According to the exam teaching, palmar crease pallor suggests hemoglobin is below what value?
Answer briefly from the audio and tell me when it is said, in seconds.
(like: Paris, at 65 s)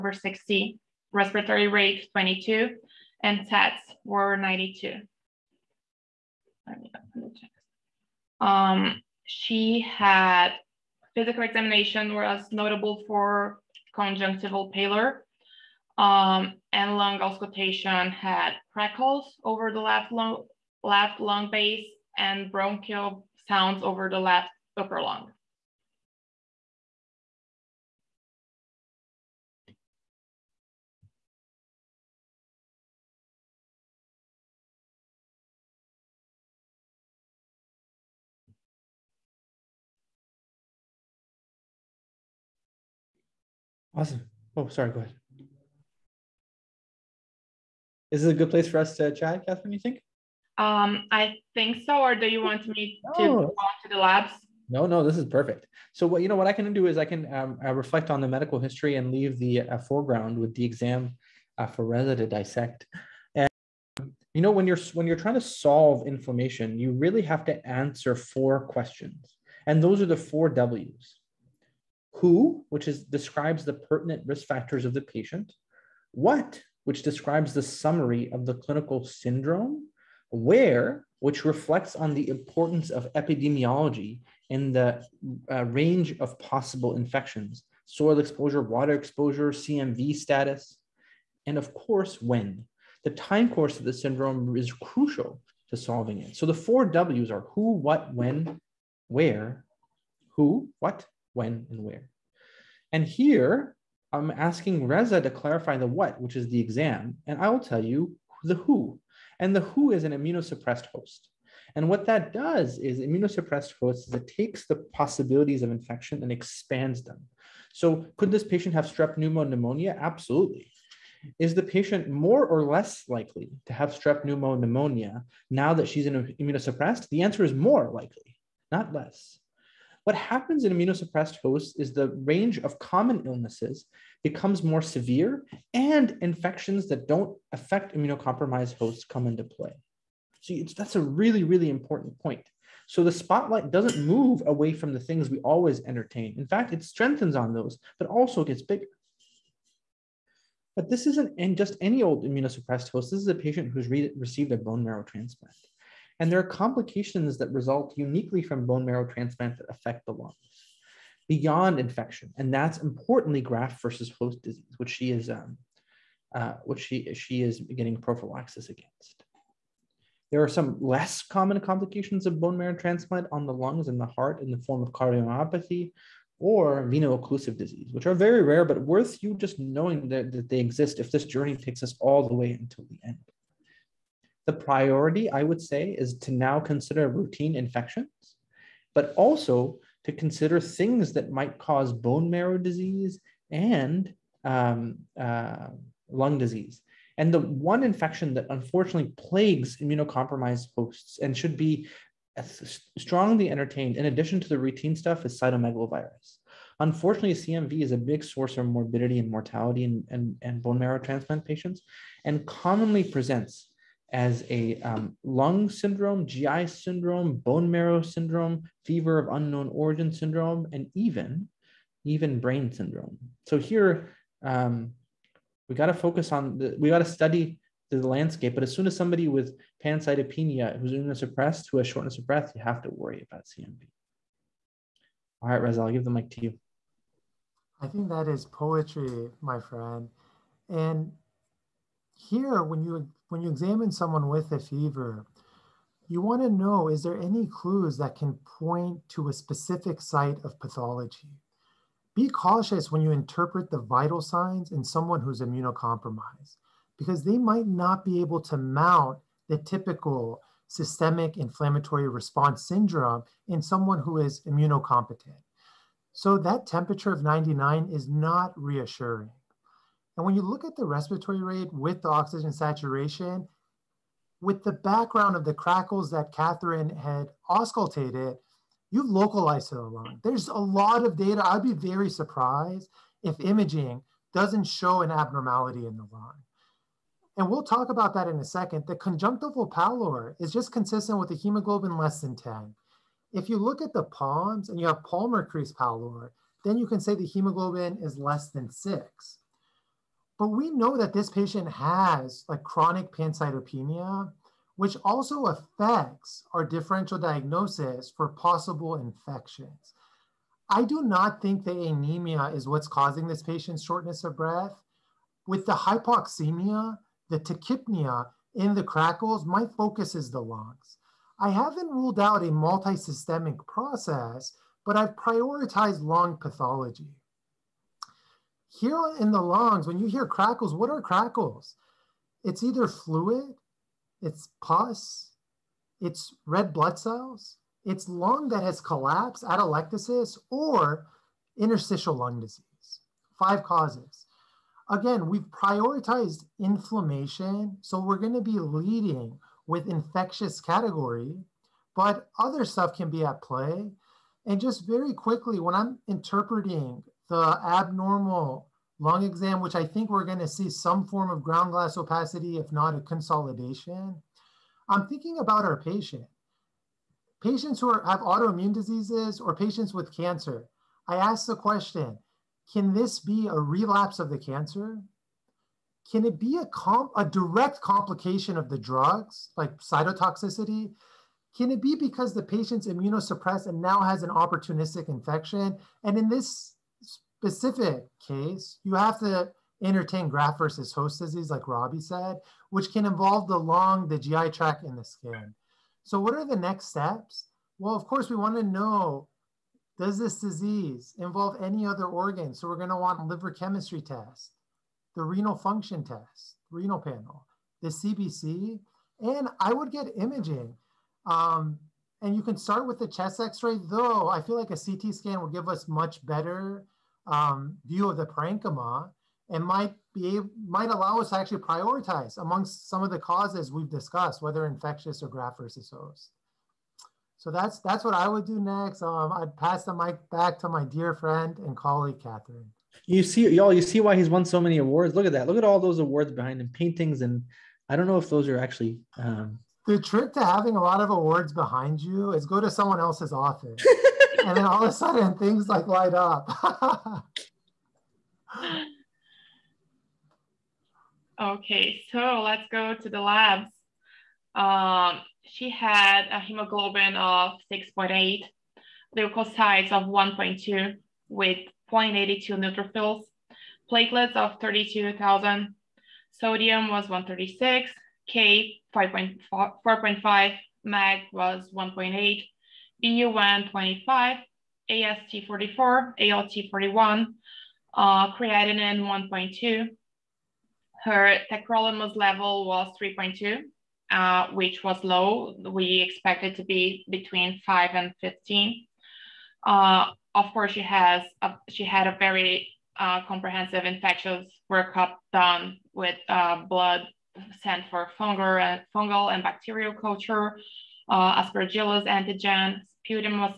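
6, at 298 s.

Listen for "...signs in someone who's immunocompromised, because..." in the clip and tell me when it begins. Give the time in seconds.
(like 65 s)
254 s.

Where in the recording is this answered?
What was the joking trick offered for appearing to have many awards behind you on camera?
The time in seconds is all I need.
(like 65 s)
442 s.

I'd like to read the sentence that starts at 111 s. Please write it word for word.
And what that does is immunosuppressed hosts, is it takes the possibilities of infection and expands them.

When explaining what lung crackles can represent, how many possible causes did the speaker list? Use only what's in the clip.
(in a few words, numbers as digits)
5.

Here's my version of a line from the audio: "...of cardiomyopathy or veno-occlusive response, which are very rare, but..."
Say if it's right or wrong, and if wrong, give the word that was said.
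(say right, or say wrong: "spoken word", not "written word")
wrong: "disease", not "response".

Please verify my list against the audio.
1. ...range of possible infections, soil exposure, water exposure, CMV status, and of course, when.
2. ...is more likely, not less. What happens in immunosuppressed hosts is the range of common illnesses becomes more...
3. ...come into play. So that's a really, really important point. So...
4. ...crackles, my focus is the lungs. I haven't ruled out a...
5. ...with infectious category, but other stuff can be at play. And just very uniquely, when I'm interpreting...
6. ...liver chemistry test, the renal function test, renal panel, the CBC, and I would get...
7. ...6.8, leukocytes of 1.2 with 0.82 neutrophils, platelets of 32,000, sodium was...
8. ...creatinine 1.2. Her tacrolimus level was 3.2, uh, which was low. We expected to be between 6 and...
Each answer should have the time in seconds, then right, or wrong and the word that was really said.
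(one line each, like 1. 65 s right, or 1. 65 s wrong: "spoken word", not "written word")
1. 85 s right
2. 127 s right
3. 139 s right
4. 318 s right
5. 349 s wrong: "quickly", not "uniquely"
6. 403 s right
7. 457 s right
8. 478 s wrong: "5", not "6".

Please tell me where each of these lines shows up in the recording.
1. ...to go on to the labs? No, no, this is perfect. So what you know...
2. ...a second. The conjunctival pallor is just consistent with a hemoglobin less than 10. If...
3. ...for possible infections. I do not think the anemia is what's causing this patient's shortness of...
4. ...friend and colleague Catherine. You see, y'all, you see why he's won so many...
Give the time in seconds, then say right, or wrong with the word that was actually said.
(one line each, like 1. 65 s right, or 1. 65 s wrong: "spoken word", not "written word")
1. 53 s right
2. 288 s right
3. 308 s right
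4. 431 s right.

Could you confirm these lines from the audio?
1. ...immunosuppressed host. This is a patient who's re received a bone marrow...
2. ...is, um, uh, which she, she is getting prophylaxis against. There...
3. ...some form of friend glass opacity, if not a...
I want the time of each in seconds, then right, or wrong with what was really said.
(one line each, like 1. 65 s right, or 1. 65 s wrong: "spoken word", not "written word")
1. 152 s right
2. 165 s right
3. 360 s wrong: "ground", not "friend".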